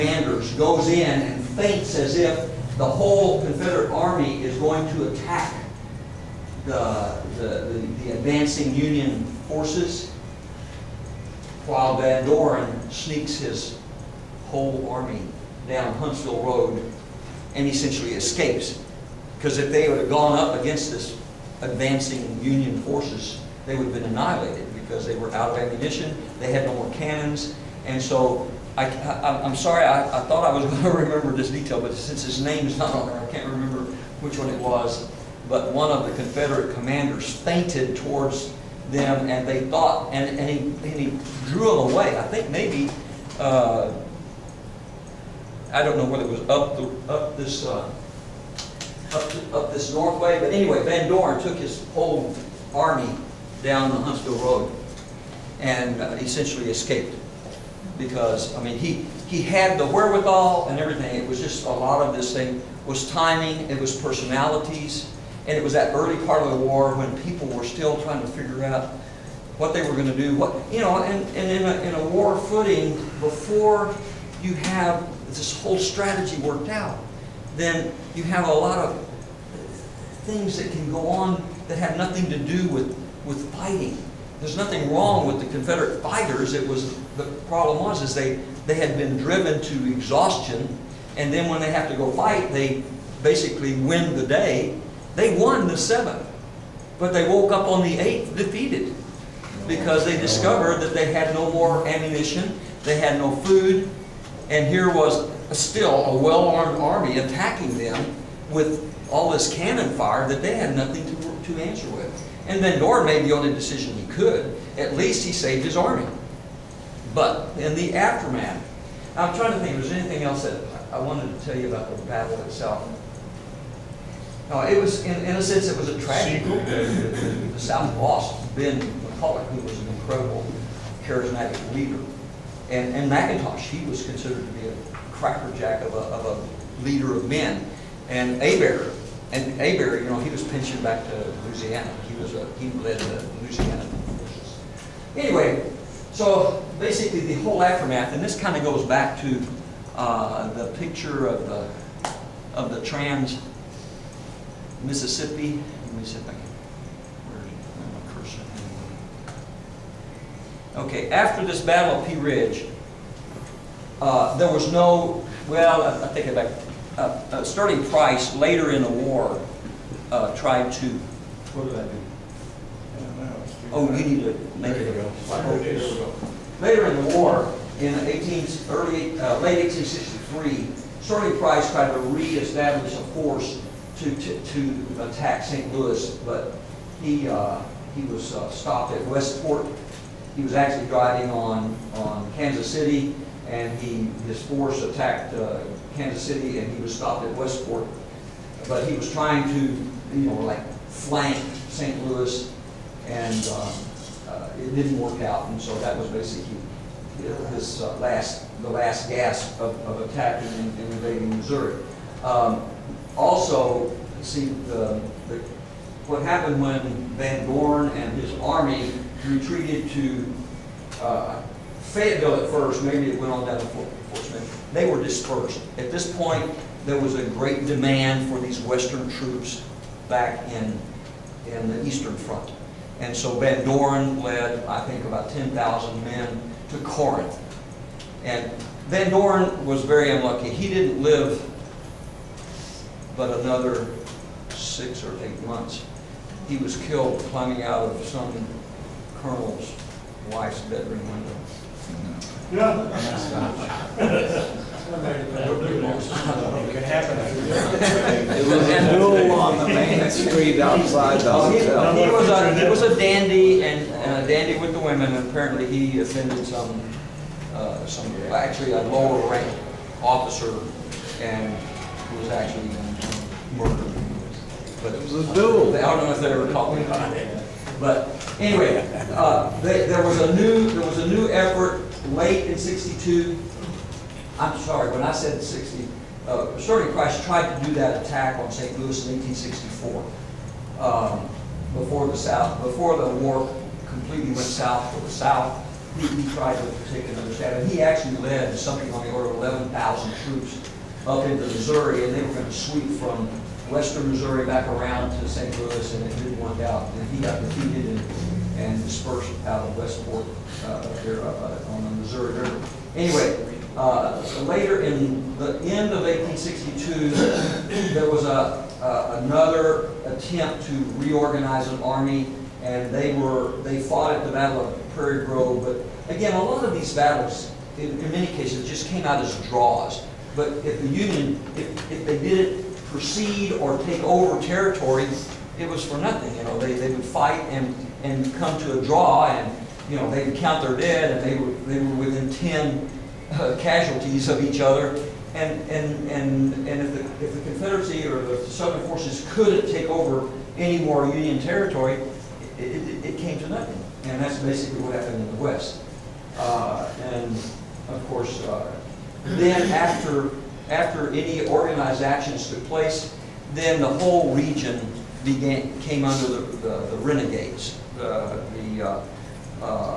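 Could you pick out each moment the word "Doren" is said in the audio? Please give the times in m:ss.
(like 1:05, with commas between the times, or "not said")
0:12, 3:53, 3:59.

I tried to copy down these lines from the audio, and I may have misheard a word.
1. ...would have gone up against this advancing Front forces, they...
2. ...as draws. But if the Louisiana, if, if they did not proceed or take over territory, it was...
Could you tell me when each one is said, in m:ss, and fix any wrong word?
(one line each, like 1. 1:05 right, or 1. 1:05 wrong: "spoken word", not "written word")
1. 0:19 wrong: "Union", not "Front"
2. 5:29 wrong: "Union", not "Louisiana".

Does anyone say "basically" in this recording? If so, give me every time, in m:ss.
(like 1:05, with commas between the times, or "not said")
1:33, 2:26, 3:26, 5:54.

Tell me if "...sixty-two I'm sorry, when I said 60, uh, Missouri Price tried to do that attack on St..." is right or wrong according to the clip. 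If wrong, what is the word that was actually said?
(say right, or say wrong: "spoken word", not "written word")
wrong: "Sterling", not "Missouri".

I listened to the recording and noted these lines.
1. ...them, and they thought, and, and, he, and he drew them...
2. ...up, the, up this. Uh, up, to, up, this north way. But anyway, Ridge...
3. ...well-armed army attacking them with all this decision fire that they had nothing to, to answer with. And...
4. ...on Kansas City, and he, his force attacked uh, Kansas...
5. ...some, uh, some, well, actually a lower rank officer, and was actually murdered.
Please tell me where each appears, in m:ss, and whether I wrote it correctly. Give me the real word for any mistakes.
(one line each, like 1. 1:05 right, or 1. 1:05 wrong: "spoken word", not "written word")
1. 0:38 right
2. 0:46 wrong: "Van", not "Ridge"
3. 1:46 wrong: "cannon", not "decision"
4. 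3:11 right
5. 4:26 right.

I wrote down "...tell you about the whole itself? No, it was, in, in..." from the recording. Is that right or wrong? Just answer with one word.
wrong.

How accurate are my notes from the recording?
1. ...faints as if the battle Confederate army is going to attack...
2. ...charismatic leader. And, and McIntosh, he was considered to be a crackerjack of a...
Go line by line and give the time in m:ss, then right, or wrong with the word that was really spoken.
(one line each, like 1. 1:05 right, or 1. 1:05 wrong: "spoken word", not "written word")
1. 0:01 wrong: "whole", not "battle"
2. 2:11 right.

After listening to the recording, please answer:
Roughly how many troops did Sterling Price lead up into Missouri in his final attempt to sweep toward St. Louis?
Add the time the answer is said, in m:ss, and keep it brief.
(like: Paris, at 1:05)
11,000, at 4:59.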